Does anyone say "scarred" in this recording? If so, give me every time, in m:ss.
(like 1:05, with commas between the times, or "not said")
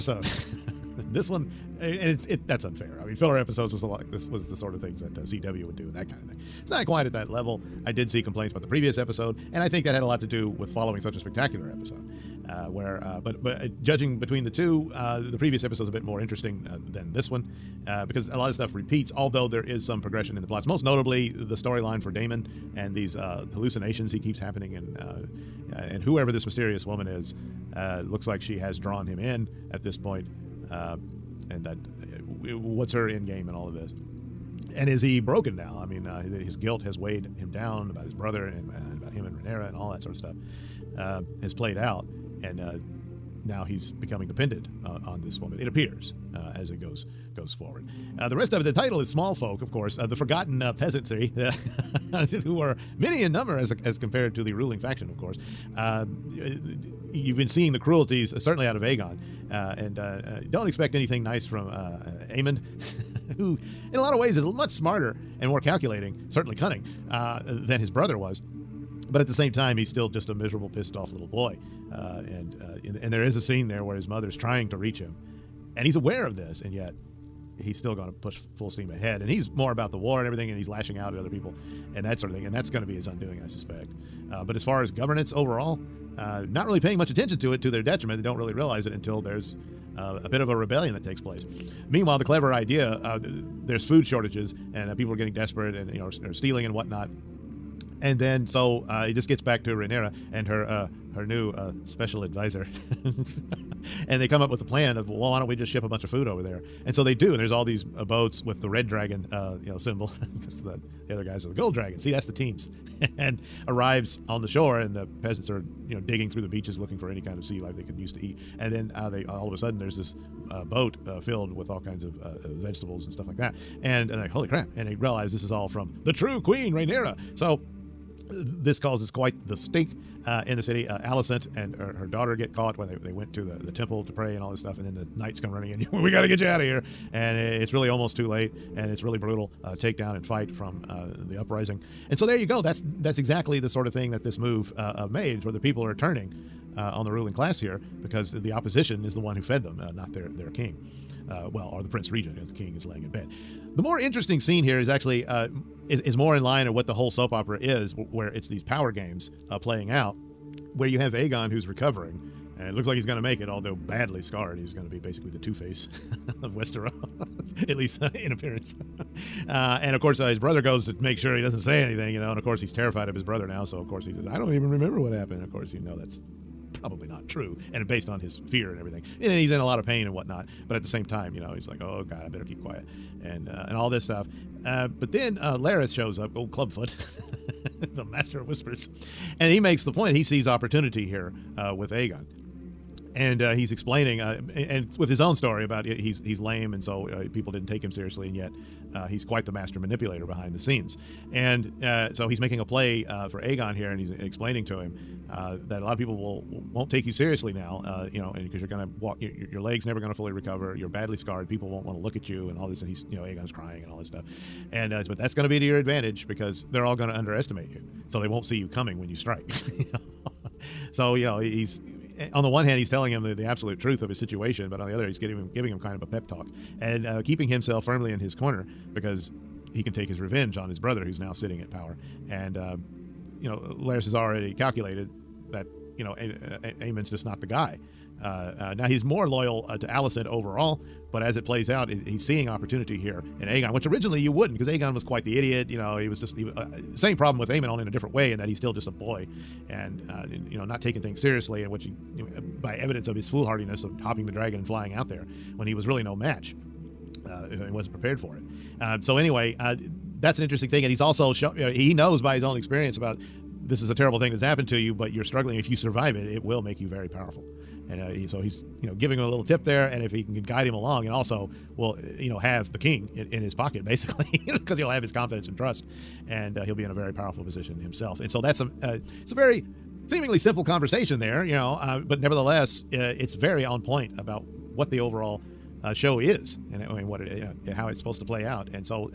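2:44, 3:31.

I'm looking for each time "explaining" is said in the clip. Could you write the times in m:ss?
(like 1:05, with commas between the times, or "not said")
3:13, 3:24.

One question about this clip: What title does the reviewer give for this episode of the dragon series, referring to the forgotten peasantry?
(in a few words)
Small Folk.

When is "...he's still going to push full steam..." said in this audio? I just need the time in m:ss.
1:17.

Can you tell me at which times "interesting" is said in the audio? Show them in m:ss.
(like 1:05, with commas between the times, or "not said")
0:16, 2:33, 4:20.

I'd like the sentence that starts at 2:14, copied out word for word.
And then the knights come running in.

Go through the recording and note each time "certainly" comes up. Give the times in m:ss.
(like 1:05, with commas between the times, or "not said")
0:58, 1:06.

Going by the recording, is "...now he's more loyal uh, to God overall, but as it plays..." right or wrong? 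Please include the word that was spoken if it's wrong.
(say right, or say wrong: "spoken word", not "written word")
wrong: "Alicent", not "God".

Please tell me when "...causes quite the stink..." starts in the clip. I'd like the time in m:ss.
2:08.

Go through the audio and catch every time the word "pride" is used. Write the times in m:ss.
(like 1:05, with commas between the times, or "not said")
not said.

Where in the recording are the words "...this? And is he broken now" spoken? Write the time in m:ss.
0:33.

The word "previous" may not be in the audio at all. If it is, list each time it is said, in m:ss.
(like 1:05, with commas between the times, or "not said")
0:08, 0:15.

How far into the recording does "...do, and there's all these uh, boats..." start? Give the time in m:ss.
1:47.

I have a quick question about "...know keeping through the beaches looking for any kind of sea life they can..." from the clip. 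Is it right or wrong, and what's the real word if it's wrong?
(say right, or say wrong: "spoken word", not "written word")
wrong: "digging", not "keeping".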